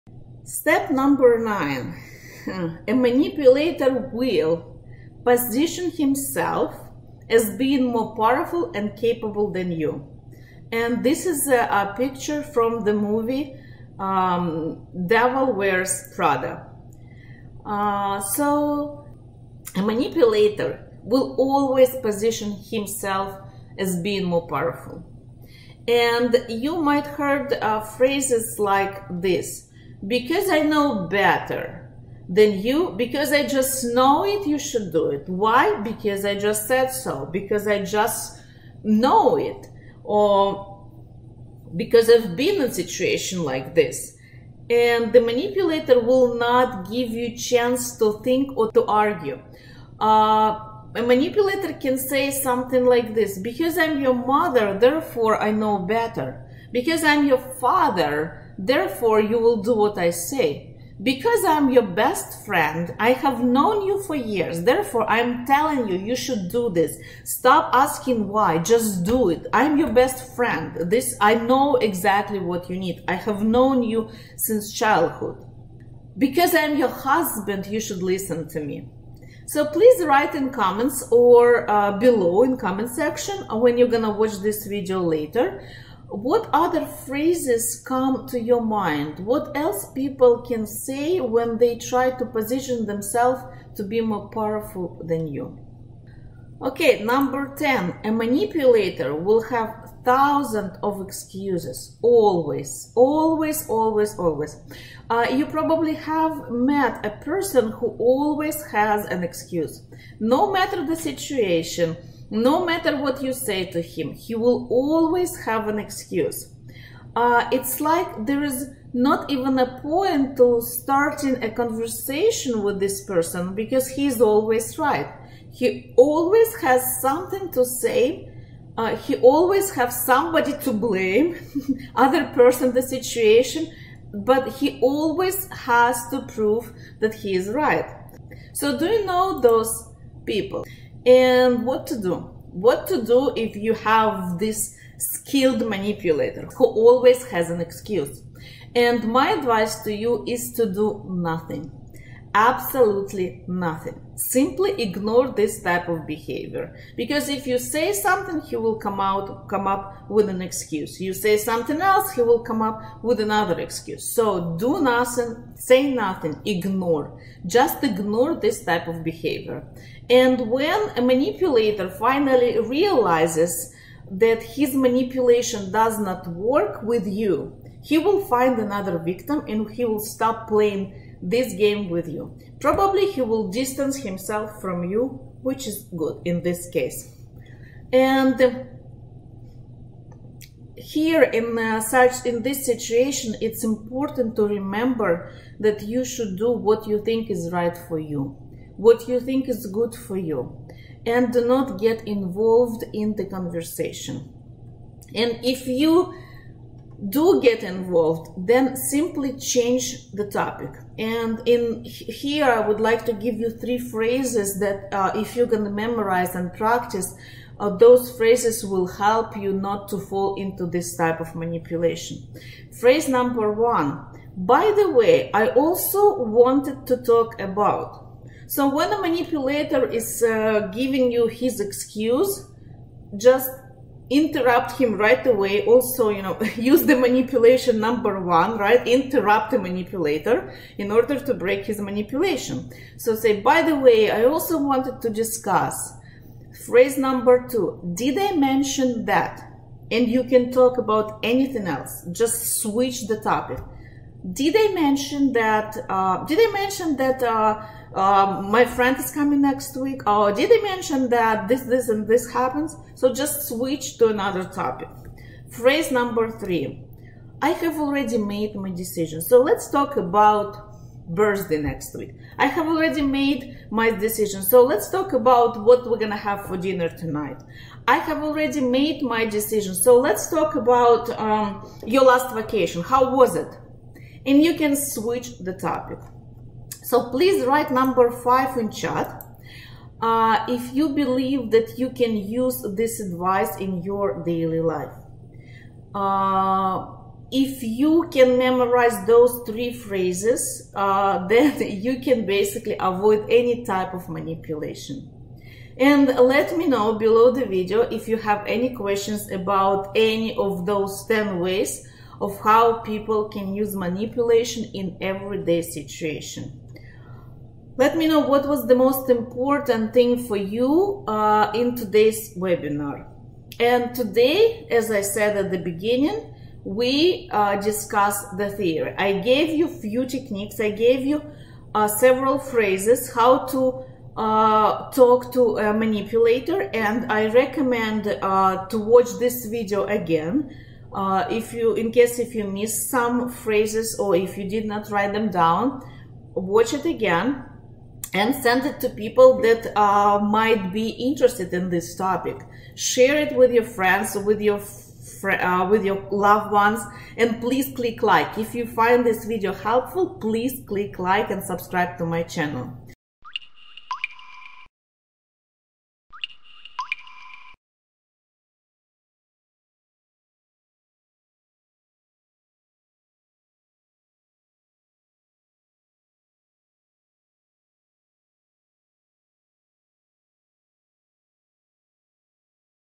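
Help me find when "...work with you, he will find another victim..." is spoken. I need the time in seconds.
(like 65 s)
176 s.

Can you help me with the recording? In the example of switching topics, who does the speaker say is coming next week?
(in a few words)
My friend.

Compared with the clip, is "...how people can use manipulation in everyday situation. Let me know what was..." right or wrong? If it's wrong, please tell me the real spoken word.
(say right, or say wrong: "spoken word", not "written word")
right.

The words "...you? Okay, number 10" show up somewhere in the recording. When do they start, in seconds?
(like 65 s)
95 s.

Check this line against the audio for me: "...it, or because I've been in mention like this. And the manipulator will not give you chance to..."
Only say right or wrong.
wrong.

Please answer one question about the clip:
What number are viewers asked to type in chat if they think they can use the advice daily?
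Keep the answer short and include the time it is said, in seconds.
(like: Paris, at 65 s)
5, at 288 s.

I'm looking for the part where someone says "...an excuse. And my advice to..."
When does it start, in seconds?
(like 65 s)
147 s.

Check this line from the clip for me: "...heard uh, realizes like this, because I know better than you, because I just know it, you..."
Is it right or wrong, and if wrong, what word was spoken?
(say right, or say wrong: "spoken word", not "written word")
wrong: "phrases", not "realizes".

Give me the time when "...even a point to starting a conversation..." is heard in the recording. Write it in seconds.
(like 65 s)
119 s.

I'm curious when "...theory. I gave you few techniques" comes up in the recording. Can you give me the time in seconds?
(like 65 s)
328 s.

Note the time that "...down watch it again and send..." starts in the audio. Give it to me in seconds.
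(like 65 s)
345 s.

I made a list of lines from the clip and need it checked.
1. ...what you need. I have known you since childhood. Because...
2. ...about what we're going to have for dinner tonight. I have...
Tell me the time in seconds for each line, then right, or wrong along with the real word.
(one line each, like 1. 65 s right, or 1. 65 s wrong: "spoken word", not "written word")
1. 72 s right
2. 275 s right.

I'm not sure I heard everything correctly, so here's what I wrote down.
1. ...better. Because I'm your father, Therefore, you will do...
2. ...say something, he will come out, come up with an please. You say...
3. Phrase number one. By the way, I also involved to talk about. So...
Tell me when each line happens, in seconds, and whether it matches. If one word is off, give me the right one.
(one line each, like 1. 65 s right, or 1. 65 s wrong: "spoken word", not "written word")
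1. 55 s right
2. 157 s wrong: "excuse", not "please"
3. 222 s wrong: "wanted", not "involved".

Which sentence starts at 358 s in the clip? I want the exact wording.
If you find this video helpful, please click like and subscribe to my channel.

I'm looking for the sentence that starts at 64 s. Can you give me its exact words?
Therefore, I'm telling you, you should do this.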